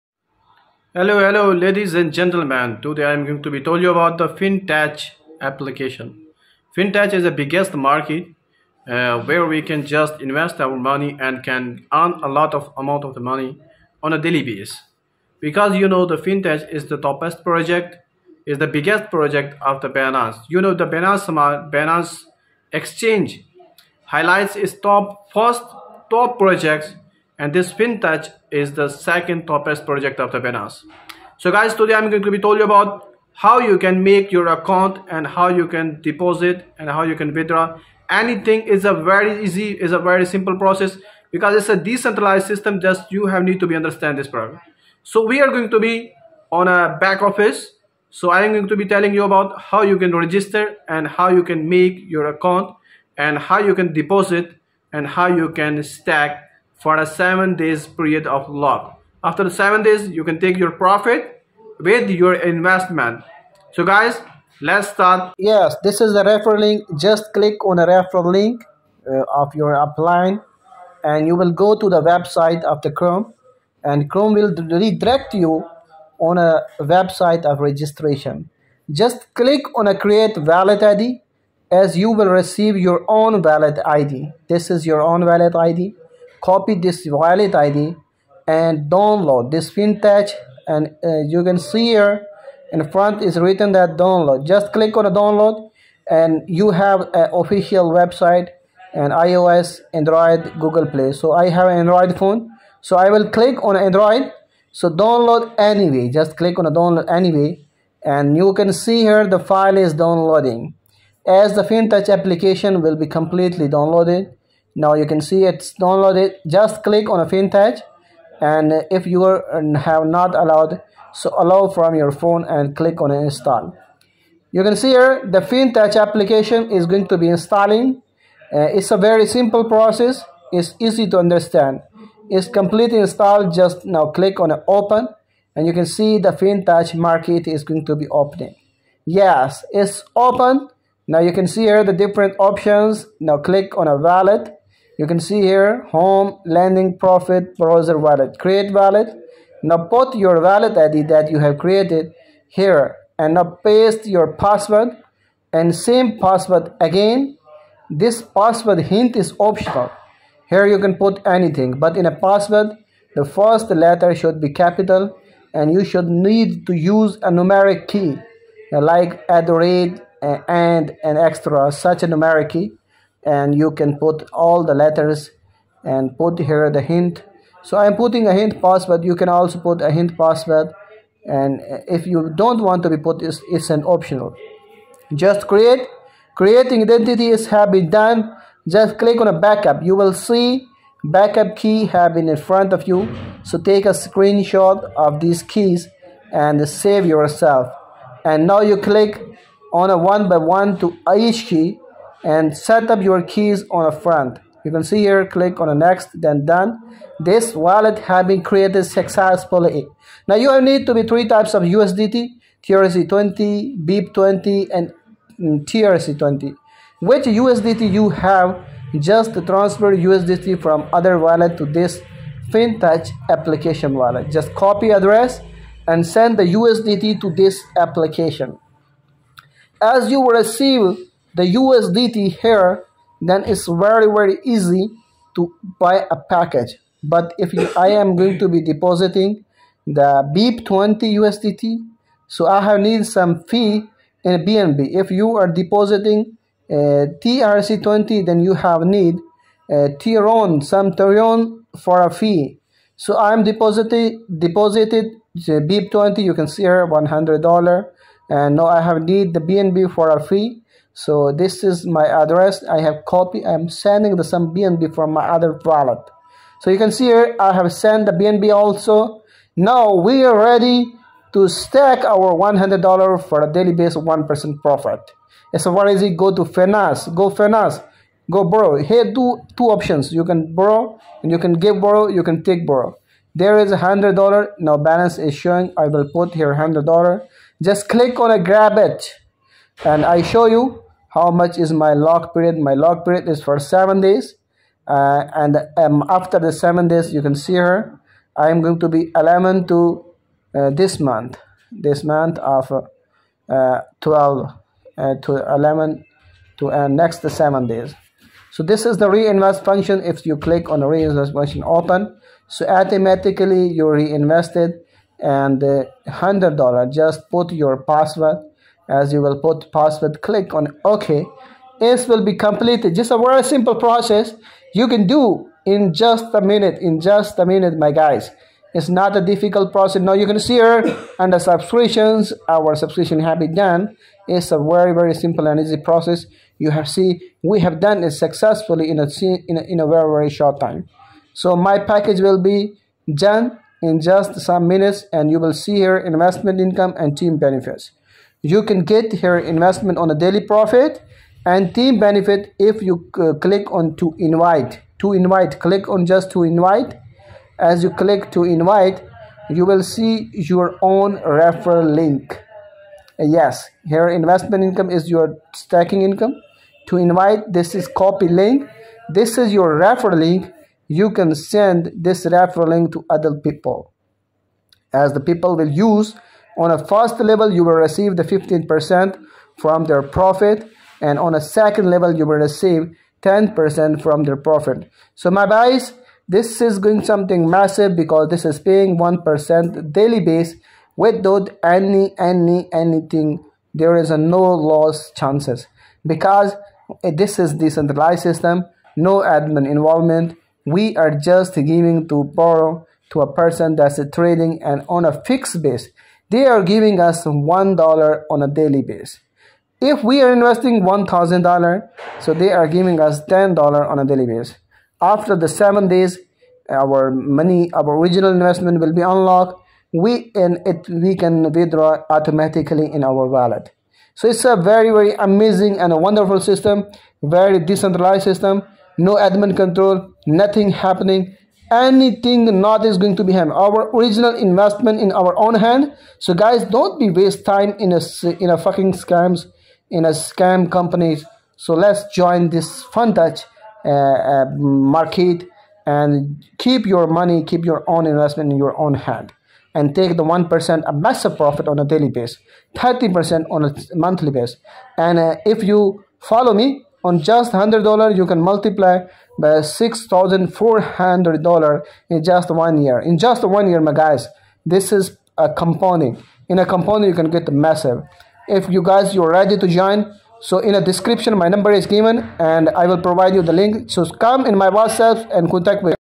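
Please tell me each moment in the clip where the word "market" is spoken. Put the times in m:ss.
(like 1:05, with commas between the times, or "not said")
0:07, 2:16, 7:24.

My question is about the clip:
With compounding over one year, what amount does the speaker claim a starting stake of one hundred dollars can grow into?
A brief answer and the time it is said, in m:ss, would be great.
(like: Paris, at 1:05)
$6400, at 7:39.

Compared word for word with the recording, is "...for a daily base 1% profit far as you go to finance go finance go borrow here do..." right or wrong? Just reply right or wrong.
right.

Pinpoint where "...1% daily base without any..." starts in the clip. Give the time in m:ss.
6:28.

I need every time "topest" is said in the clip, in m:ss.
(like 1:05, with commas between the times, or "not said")
0:16.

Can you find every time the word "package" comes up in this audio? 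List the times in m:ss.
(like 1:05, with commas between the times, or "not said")
3:56, 5:41.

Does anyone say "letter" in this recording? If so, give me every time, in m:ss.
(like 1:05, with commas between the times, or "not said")
2:43, 2:54.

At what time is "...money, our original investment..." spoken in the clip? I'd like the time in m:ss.
6:57.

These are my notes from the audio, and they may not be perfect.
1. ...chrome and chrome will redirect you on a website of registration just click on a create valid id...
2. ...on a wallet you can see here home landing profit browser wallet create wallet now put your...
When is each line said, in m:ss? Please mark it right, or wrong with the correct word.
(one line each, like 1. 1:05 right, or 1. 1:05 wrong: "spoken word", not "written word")
1. 1:12 right
2. 2:23 right.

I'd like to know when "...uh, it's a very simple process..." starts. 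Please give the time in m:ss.
2:08.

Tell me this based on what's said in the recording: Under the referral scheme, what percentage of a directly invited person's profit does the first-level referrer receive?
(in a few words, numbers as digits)
15%.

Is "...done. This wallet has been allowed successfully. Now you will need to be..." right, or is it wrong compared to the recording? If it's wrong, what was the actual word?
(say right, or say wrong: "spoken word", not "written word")
wrong: "created", not "allowed".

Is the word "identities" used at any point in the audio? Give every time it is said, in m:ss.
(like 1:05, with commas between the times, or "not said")
3:06.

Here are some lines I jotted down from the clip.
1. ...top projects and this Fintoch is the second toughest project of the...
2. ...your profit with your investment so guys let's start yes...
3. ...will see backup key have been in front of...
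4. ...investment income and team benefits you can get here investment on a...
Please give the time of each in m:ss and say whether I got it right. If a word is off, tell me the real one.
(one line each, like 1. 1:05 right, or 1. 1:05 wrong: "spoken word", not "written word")
1. 0:26 right
2. 1:00 right
3. 3:09 right
4. 5:45 right.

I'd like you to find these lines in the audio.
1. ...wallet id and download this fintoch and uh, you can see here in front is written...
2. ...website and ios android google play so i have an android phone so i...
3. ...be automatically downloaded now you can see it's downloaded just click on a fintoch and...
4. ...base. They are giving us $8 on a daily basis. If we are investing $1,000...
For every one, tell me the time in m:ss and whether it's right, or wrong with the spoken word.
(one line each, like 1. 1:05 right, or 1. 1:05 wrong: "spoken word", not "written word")
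1. 1:27 right
2. 1:37 right
3. 1:52 wrong: "completely", not "automatically"
4. 6:45 wrong: "1", not "8".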